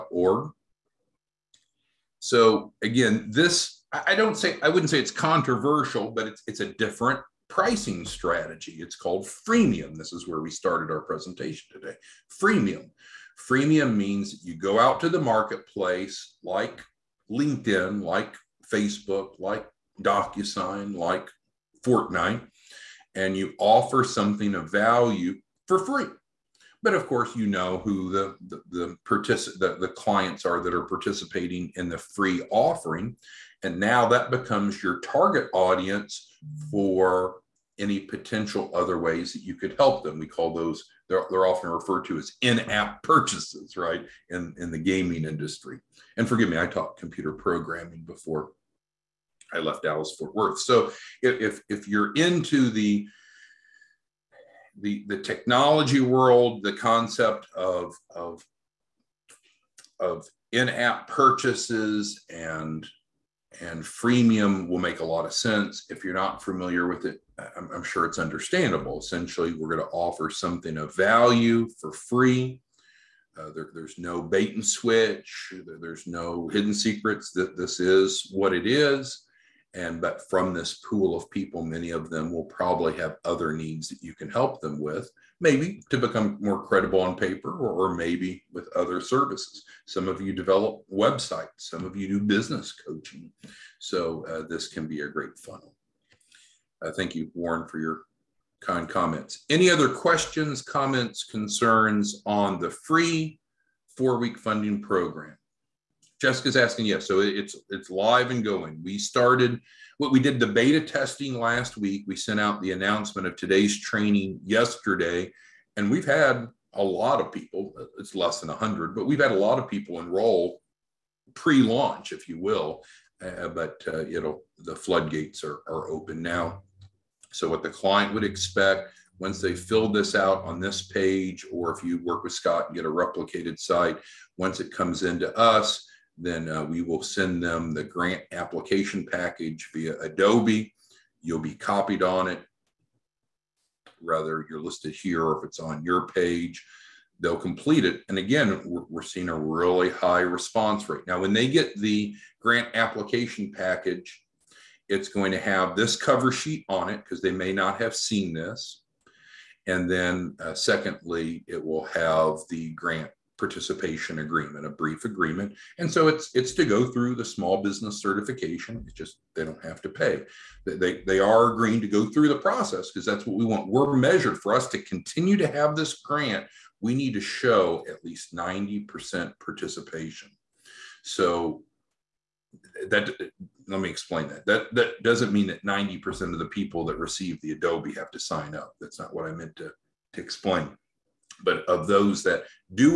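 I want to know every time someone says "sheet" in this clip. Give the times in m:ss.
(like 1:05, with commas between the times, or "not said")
2:36.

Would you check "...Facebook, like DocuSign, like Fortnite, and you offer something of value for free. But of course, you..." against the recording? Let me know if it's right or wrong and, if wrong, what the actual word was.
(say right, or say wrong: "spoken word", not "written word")
right.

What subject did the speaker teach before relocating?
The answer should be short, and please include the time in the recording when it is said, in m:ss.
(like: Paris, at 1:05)
computer programming, at 0:46.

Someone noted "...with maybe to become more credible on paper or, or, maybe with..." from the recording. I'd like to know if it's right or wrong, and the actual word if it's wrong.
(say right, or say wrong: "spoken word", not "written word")
right.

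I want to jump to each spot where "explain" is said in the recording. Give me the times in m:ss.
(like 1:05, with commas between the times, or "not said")
3:03, 3:10.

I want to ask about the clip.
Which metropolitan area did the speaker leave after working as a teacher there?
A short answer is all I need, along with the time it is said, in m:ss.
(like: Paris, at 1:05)
Dallas Fort Worth, at 0:49.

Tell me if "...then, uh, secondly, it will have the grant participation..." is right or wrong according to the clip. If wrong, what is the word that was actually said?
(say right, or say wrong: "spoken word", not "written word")
right.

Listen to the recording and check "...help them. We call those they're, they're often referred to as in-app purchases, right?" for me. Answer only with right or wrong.
right.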